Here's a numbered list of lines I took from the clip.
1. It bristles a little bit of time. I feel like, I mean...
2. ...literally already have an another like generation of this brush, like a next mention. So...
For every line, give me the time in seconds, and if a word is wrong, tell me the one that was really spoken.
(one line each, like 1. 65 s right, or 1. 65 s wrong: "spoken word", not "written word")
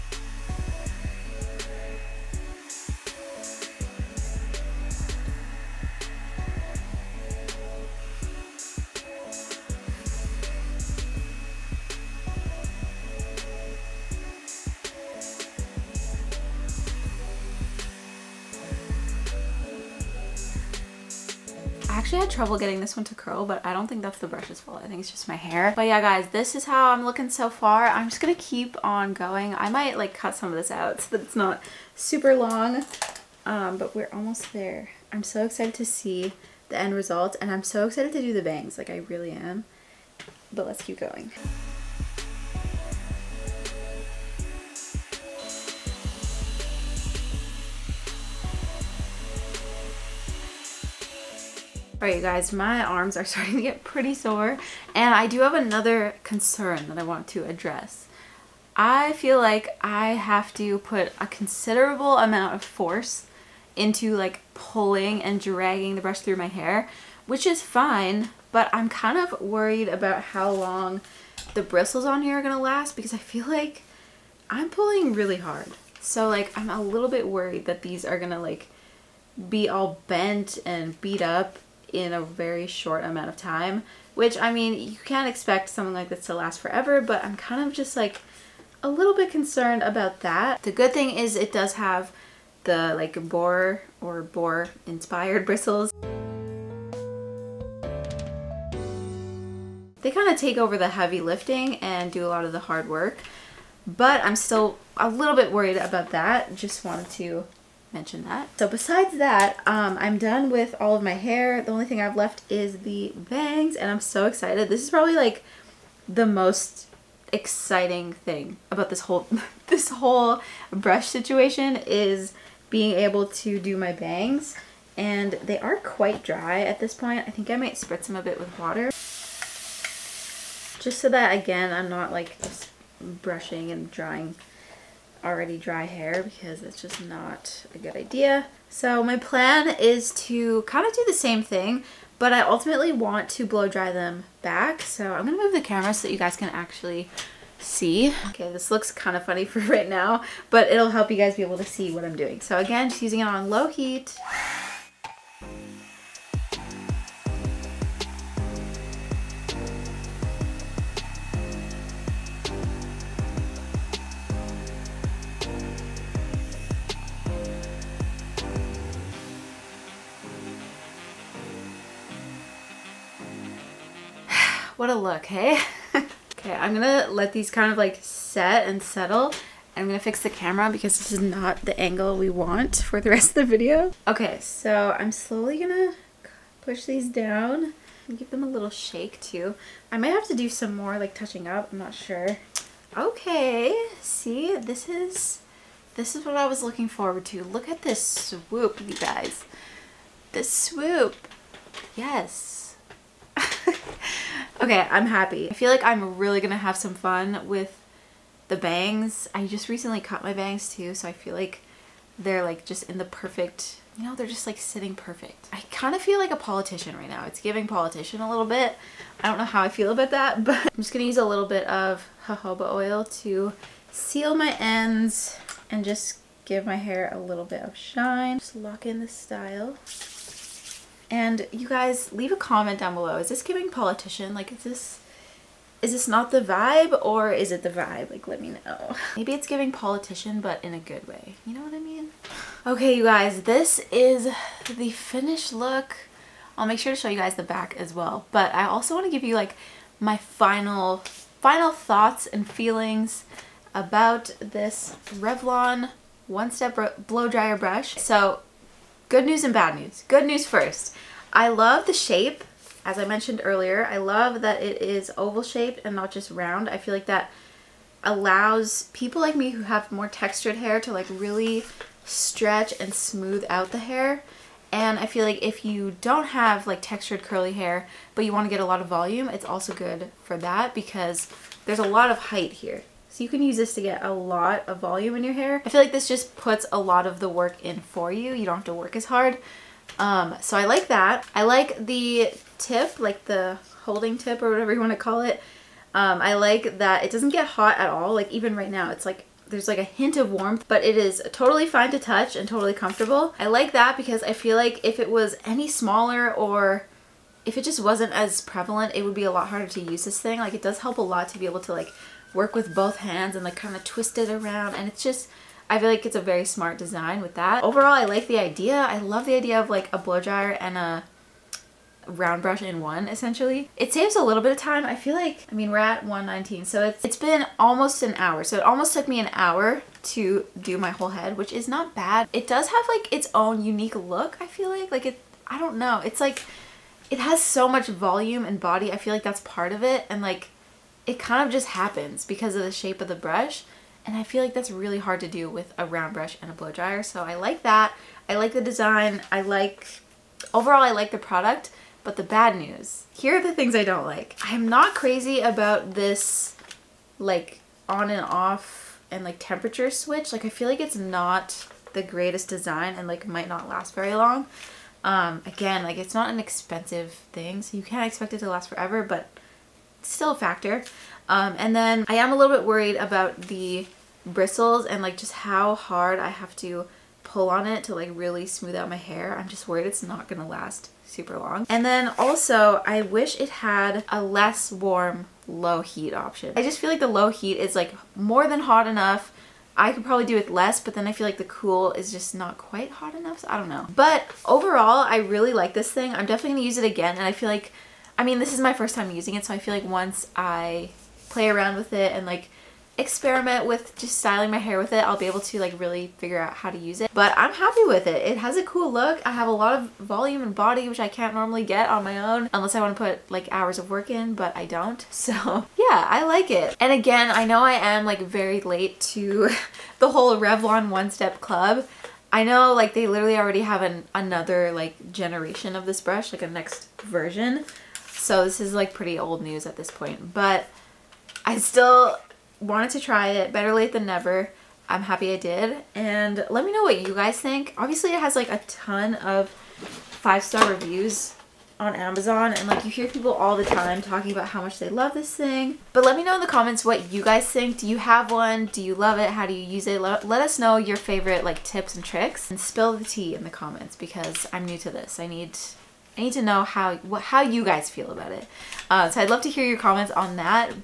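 1. 323 s wrong: "saves", not "bristles"
2. 423 s wrong: "version", not "mention".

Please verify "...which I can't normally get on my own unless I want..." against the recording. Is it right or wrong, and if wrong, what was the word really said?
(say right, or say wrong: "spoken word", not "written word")
right.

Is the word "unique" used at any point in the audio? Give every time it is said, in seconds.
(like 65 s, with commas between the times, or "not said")
333 s.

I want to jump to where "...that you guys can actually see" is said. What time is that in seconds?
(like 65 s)
146 s.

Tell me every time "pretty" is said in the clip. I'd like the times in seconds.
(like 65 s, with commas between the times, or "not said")
53 s, 428 s.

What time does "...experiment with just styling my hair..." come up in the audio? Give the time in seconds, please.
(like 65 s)
402 s.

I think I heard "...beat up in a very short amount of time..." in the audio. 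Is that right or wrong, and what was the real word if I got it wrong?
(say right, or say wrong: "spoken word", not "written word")
right.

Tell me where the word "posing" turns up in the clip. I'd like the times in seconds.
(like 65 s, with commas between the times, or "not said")
not said.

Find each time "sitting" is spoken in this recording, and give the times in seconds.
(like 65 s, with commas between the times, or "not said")
214 s.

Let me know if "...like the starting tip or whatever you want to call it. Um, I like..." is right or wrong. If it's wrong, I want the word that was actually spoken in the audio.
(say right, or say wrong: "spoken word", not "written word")
wrong: "holding", not "starting".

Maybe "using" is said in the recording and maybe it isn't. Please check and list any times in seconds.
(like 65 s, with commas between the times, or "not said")
153 s, 399 s.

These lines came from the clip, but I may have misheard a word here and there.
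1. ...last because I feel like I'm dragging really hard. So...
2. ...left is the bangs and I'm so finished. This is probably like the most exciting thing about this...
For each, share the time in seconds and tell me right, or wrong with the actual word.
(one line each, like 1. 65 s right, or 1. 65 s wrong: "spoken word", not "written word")
1. 72 s wrong: "pulling", not "dragging"
2. 112 s wrong: "excited", not "finished".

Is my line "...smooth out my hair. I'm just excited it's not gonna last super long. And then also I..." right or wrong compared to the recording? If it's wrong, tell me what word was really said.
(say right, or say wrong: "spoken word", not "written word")
wrong: "worried", not "excited".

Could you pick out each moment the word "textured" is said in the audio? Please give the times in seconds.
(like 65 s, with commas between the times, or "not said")
270 s, 276 s.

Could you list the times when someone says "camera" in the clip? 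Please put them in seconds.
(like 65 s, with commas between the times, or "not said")
145 s, 180 s.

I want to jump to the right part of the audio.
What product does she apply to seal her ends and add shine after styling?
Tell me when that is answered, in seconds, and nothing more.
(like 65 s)
222 s.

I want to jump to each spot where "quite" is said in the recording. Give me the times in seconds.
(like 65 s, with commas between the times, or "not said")
125 s, 392 s.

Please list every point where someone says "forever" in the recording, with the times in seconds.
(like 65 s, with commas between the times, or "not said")
86 s, 368 s.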